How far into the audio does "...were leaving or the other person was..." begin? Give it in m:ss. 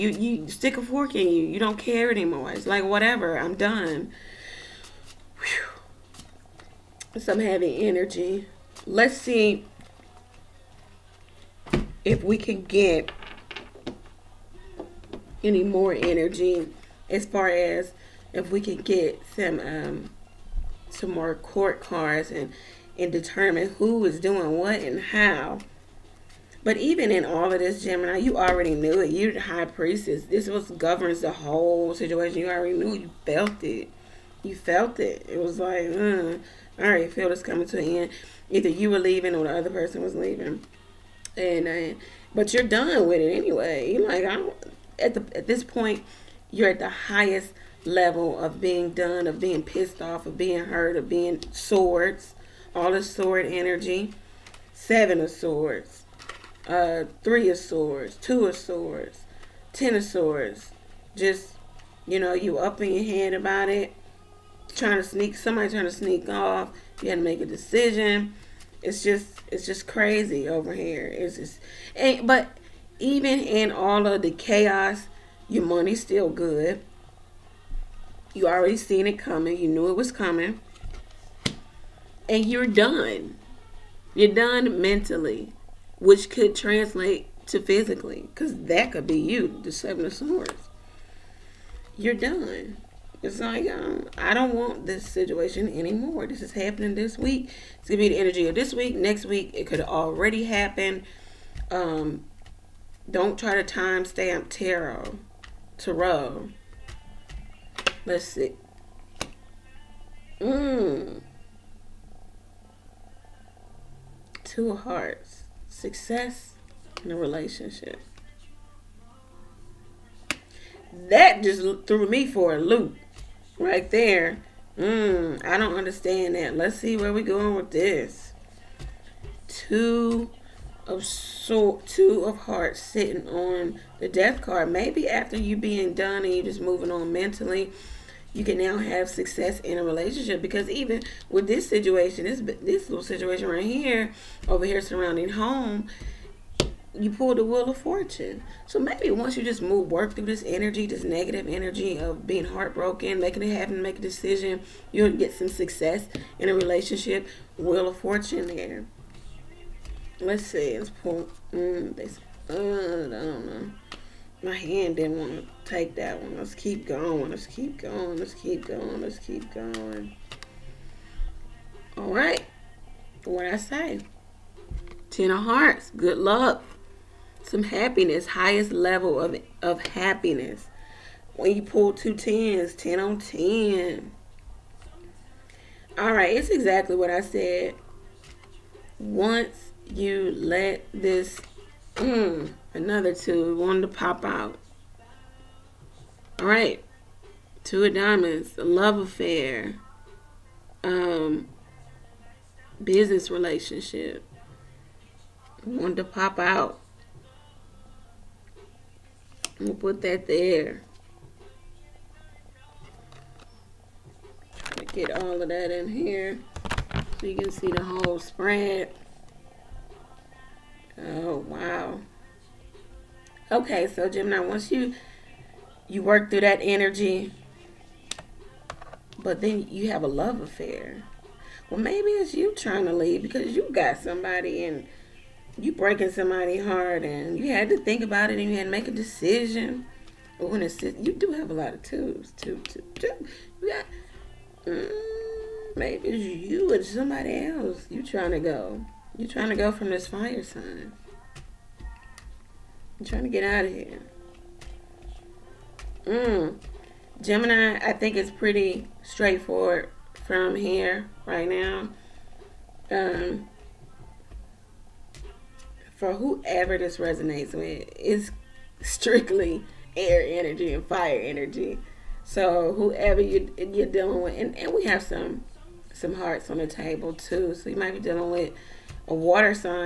0:38.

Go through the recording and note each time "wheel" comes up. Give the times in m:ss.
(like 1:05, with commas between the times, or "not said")
2:27, 2:37.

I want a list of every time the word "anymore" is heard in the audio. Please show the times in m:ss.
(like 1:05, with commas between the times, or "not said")
0:02, 1:35.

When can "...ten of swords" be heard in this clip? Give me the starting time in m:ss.
0:59.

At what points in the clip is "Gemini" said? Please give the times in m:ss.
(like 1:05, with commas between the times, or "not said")
0:27, 3:44, 4:17.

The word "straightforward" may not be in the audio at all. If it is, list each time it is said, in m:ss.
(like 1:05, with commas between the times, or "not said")
4:19.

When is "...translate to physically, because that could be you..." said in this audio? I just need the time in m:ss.
1:26.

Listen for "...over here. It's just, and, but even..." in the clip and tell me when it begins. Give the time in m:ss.
1:10.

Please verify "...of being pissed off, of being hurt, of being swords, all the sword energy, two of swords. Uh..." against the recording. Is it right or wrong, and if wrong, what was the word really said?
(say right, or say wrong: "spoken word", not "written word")
wrong: "seven", not "two".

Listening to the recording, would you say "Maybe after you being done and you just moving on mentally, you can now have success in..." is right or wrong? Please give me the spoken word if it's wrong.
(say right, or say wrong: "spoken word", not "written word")
right.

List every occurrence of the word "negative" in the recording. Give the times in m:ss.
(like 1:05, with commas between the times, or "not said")
2:31.